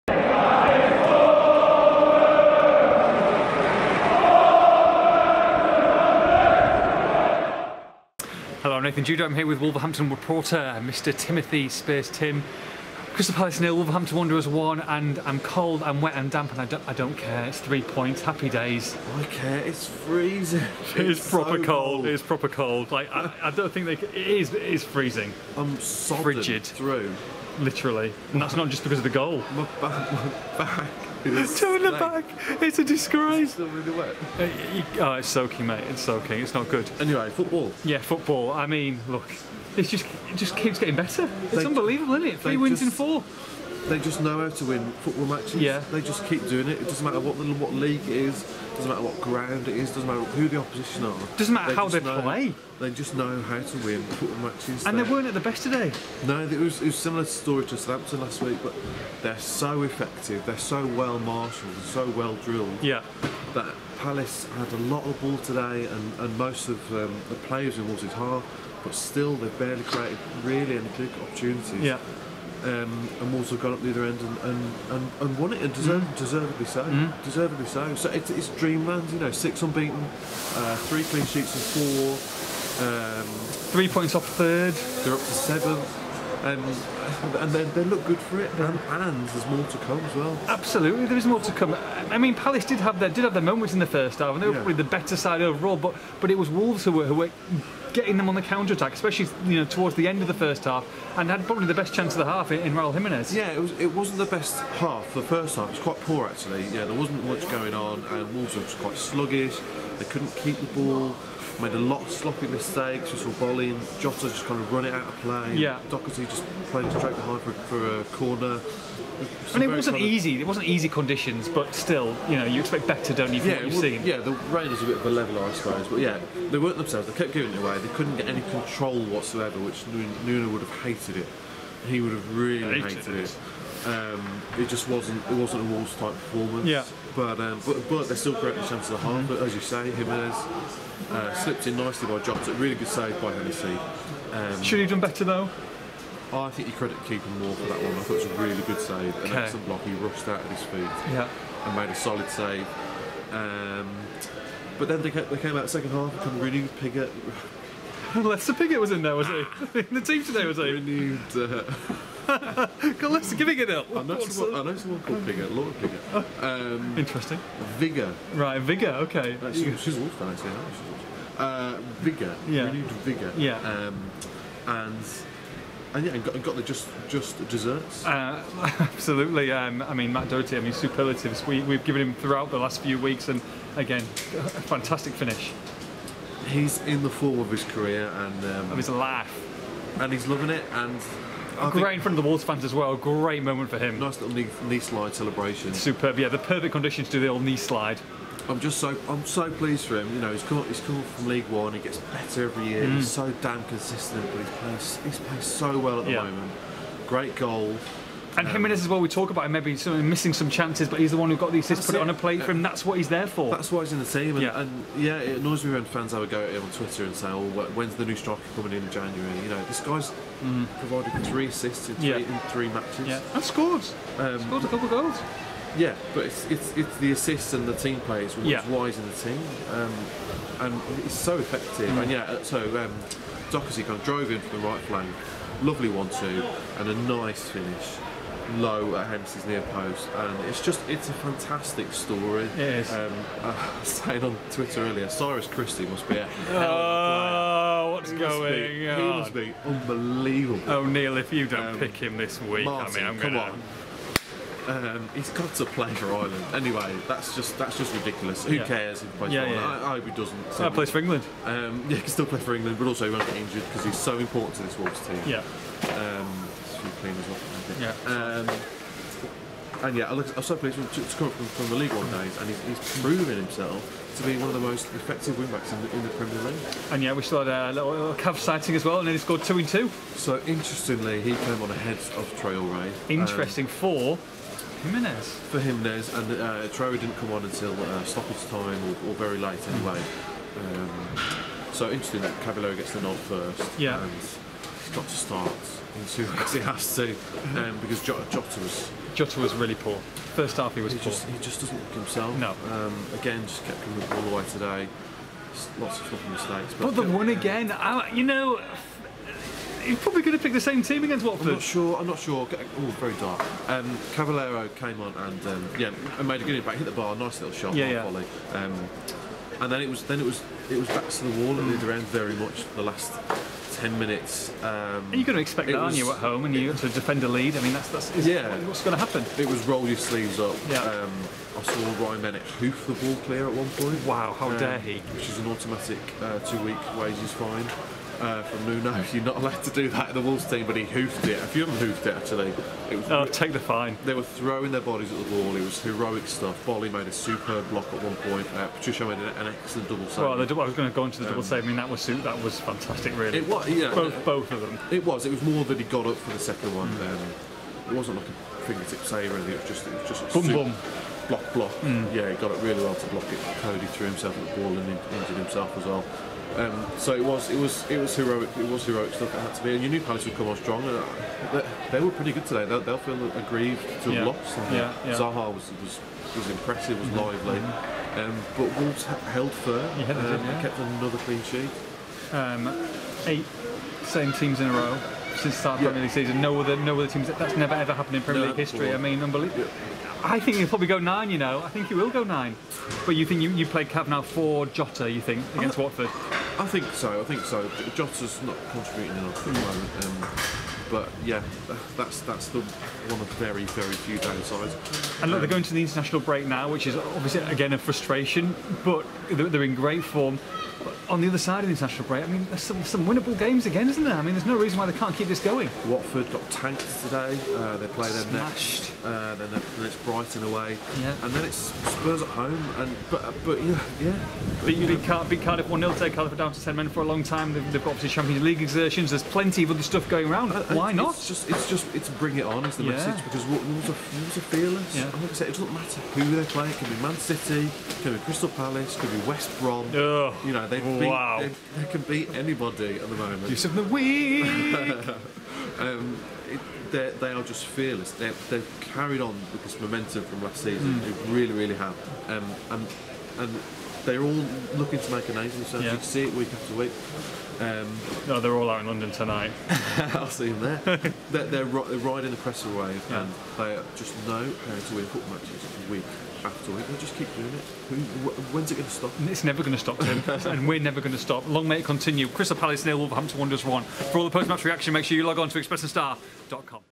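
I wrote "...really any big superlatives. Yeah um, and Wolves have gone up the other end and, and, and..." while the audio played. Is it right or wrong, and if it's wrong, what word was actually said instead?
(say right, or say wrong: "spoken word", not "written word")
wrong: "opportunities", not "superlatives".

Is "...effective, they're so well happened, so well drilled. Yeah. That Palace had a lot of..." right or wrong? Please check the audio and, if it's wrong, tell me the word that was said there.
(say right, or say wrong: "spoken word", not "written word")
wrong: "marshalled", not "happened".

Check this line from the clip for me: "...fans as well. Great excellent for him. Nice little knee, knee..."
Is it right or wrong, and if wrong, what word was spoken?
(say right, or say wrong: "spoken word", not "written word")
wrong: "moment", not "excellent".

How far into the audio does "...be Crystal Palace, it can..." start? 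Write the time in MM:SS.
07:18.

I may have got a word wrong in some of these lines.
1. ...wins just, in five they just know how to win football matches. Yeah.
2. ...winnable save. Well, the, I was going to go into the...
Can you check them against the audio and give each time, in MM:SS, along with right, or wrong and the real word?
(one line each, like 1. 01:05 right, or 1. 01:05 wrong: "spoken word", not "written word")
1. 00:42 wrong: "four", not "five"
2. 05:49 wrong: "double", not "winnable".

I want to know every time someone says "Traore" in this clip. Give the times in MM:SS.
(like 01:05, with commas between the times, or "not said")
04:42, 04:46.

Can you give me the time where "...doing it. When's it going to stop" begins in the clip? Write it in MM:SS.
07:47.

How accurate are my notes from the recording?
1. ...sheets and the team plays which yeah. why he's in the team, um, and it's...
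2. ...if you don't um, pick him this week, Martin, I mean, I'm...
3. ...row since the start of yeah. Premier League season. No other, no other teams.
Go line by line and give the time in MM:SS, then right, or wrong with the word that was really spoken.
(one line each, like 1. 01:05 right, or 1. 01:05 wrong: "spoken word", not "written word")
1. 03:47 wrong: "assists", not "sheets"
2. 04:11 right
3. 06:24 right.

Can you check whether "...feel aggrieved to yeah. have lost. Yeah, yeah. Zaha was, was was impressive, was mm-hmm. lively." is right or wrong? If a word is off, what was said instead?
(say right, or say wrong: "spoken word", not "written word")
right.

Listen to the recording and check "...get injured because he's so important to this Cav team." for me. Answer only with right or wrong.
wrong.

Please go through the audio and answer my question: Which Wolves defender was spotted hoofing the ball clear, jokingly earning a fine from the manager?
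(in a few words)
Ryan Bennett.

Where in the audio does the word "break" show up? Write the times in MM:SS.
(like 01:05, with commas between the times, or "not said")
06:46, 06:52.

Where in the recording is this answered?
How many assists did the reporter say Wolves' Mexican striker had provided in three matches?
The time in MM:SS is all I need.
03:41.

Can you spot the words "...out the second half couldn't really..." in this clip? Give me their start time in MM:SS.
02:35.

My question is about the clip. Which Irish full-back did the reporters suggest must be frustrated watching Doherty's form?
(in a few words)
Cyrus Christie.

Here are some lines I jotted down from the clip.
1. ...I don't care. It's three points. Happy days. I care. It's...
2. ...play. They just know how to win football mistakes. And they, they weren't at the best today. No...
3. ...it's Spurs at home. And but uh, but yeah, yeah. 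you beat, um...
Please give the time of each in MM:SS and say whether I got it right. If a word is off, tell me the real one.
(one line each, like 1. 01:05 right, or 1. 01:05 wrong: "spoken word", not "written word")
1. 00:16 right
2. 00:52 wrong: "matches", not "mistakes"
3. 07:01 right.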